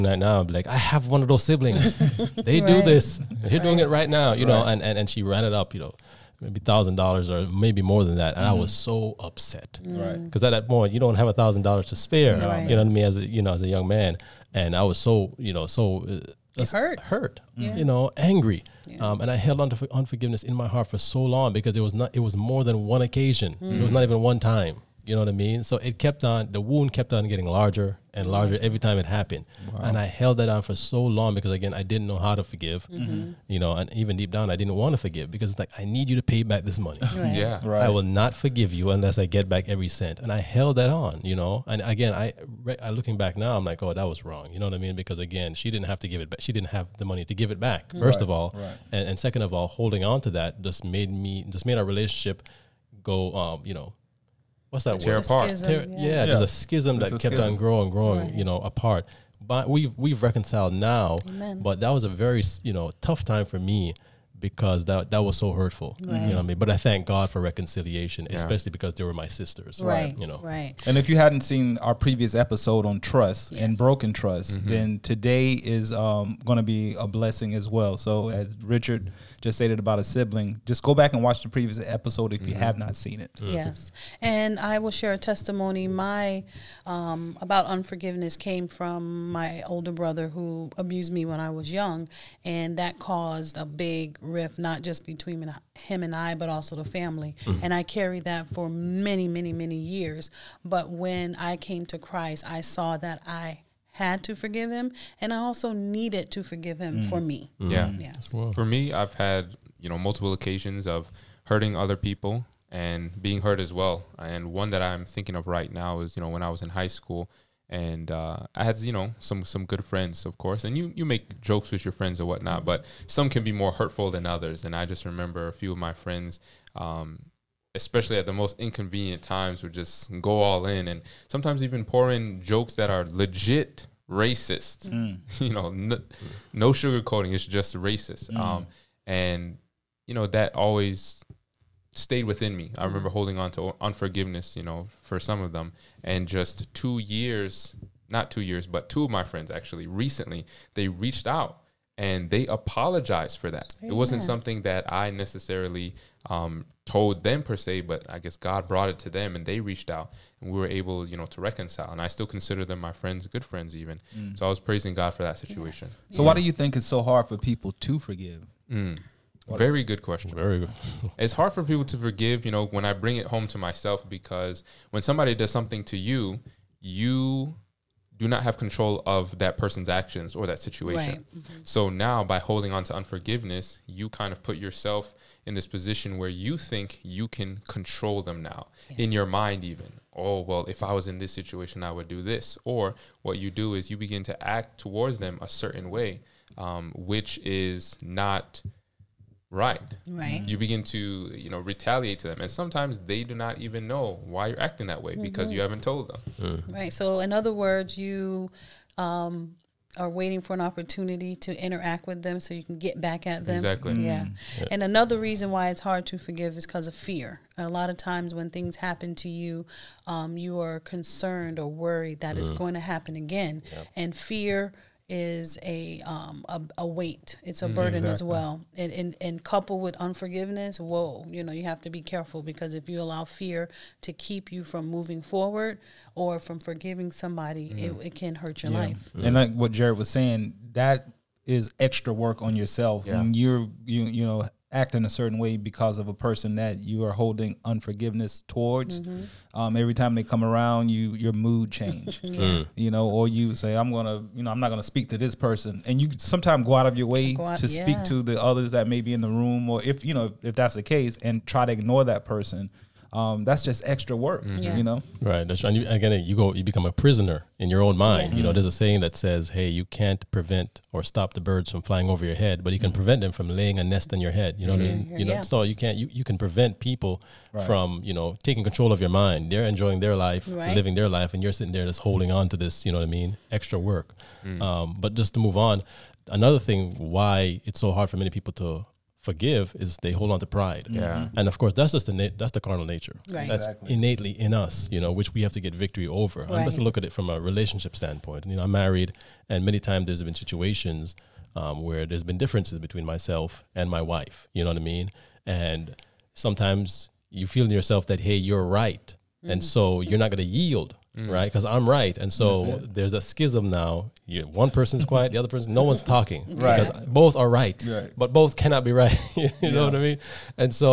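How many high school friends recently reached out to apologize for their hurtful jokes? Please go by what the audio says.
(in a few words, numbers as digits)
2.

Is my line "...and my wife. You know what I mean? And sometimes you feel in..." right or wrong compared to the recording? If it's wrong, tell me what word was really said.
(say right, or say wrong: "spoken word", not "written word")
right.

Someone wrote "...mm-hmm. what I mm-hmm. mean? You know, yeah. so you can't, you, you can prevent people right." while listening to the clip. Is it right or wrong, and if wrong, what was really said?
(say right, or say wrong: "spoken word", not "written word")
right.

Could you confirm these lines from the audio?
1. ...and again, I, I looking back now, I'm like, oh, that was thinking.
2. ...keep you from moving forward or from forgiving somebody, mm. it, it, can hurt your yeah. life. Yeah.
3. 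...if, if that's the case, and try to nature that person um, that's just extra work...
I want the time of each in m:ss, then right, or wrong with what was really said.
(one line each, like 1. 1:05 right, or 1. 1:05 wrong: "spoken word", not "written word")
1. 0:41 wrong: "wrong", not "thinking"
2. 3:54 right
3. 4:20 wrong: "ignore", not "nature".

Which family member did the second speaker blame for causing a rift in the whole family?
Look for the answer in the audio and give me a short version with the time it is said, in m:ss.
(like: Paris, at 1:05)
older brother, at 1:29.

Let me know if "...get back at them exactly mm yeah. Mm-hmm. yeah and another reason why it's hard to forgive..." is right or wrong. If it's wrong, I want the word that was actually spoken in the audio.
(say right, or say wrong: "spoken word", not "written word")
right.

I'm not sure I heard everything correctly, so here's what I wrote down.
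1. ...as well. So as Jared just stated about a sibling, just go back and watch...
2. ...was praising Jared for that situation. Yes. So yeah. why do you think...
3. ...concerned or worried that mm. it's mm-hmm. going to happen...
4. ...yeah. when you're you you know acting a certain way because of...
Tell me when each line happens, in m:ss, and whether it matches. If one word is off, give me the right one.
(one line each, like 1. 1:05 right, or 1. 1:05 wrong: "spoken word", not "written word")
1. 1:17 wrong: "Richard", not "Jared"
2. 2:44 wrong: "God", not "Jared"
3. 3:40 right
4. 4:03 right.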